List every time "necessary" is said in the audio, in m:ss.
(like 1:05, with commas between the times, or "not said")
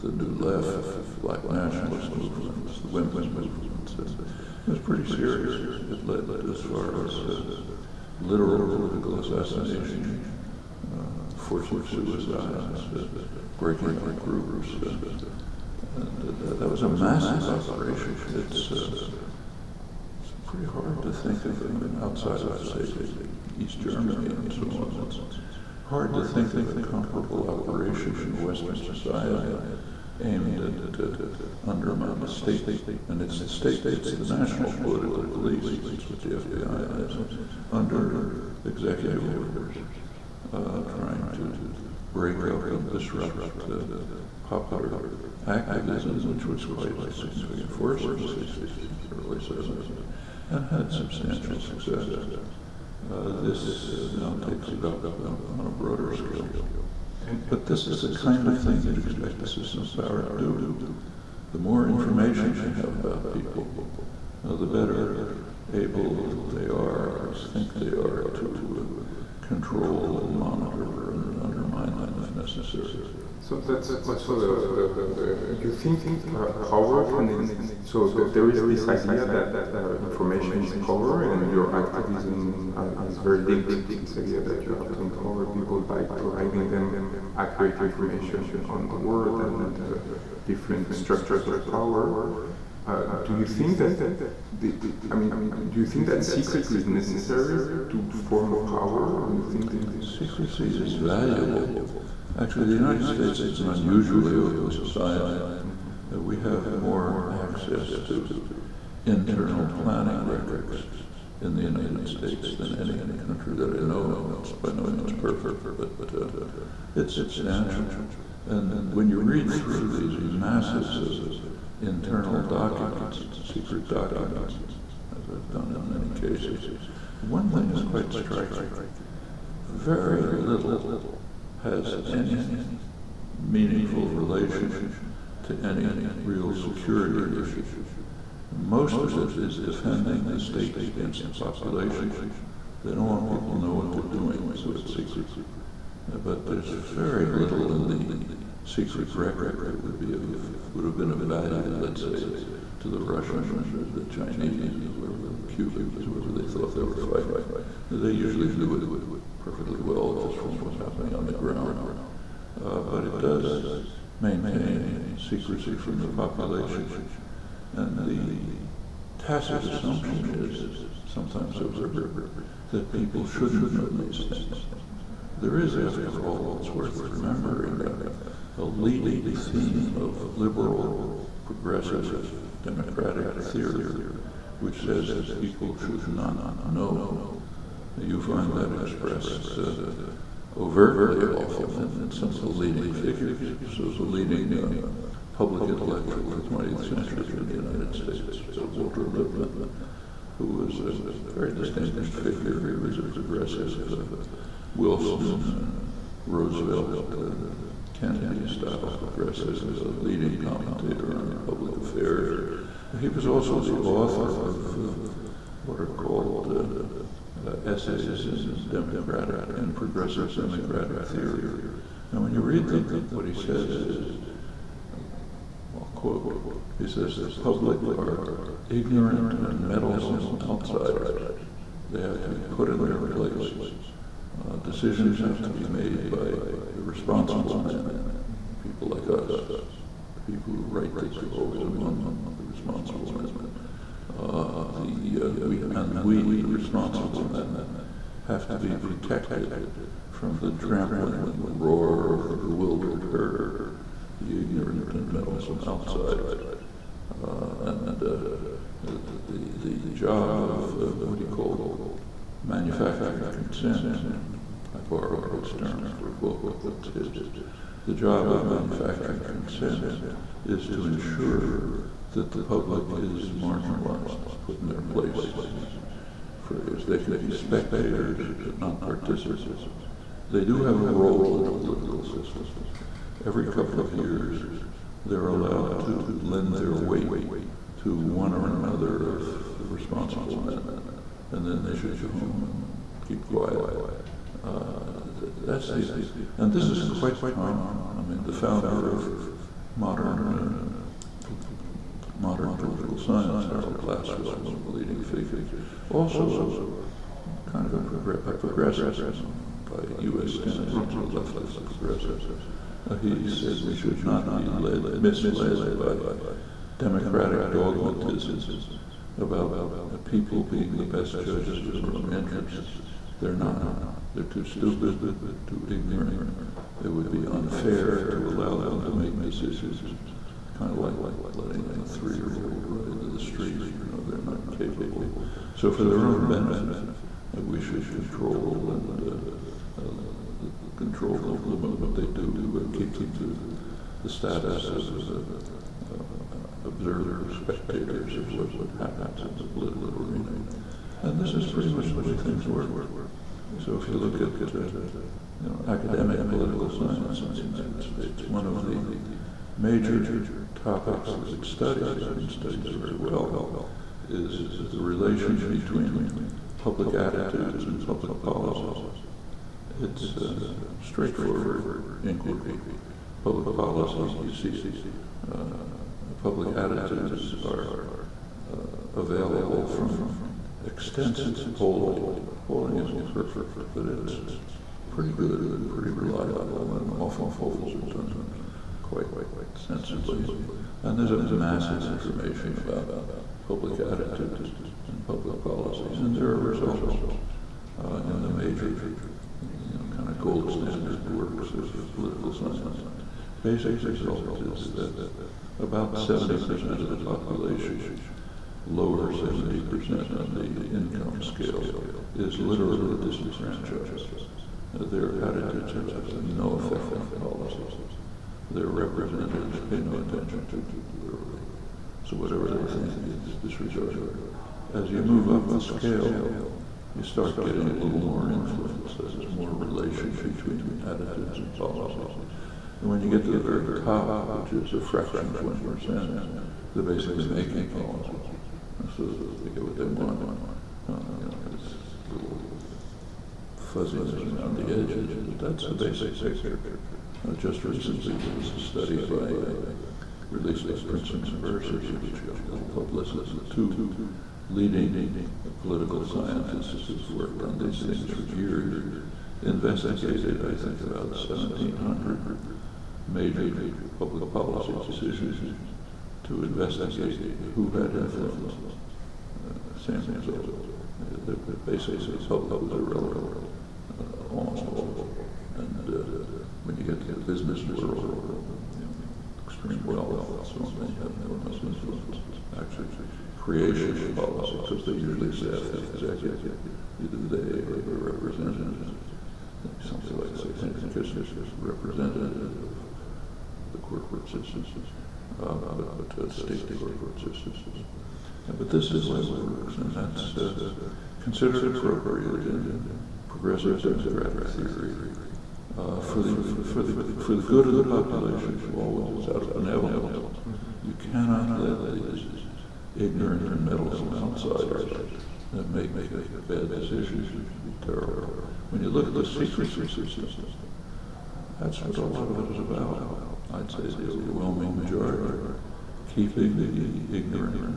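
1:12, 1:36.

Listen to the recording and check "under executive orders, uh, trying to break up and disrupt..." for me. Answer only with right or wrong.
right.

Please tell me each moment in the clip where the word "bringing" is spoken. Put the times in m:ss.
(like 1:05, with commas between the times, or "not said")
not said.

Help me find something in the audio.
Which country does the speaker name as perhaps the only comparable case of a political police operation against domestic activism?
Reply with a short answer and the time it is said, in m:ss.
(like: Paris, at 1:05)
East Germany, at 0:23.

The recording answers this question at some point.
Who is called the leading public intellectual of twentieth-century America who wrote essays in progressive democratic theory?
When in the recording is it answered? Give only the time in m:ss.
3:18.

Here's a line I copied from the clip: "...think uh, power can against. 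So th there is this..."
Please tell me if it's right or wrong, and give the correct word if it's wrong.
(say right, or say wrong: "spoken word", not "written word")
wrong: "exist", not "against".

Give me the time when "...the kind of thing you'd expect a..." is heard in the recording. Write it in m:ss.
0:57.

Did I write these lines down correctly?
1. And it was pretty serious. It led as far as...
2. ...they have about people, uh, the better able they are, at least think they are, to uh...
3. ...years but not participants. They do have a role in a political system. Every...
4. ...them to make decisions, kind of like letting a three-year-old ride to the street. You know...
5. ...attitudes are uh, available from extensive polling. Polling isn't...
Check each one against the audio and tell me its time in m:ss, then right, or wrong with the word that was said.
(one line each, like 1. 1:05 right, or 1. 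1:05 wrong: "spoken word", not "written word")
1. 0:03 right
2. 1:02 right
3. 4:37 wrong: "spectators", not "years"
4. 5:28 right
5. 6:16 right.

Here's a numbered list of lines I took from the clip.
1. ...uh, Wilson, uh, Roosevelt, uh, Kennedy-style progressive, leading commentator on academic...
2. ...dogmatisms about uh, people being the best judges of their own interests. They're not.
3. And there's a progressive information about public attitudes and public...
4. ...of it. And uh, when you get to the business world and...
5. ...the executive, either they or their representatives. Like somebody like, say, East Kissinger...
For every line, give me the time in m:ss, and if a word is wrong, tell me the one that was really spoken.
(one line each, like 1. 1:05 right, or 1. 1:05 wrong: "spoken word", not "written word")
1. 3:23 wrong: "public", not "academic"
2. 5:17 right
3. 6:30 wrong: "massive", not "progressive"
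4. 7:54 right
5. 8:05 wrong: "Henry", not "East".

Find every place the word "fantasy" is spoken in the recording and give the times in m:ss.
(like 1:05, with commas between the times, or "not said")
not said.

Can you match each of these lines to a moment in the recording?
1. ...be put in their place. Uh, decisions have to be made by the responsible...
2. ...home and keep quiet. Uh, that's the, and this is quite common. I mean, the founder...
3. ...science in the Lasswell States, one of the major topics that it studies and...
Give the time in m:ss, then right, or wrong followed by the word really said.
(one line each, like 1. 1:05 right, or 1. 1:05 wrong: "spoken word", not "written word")
1. 3:52 right
2. 4:52 right
3. 5:56 wrong: "United", not "Lasswell".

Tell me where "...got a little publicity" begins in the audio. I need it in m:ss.
7:32.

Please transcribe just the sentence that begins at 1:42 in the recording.
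Actually, the United States is an unusually open society.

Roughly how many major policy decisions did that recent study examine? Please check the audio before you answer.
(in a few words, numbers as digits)
1,700.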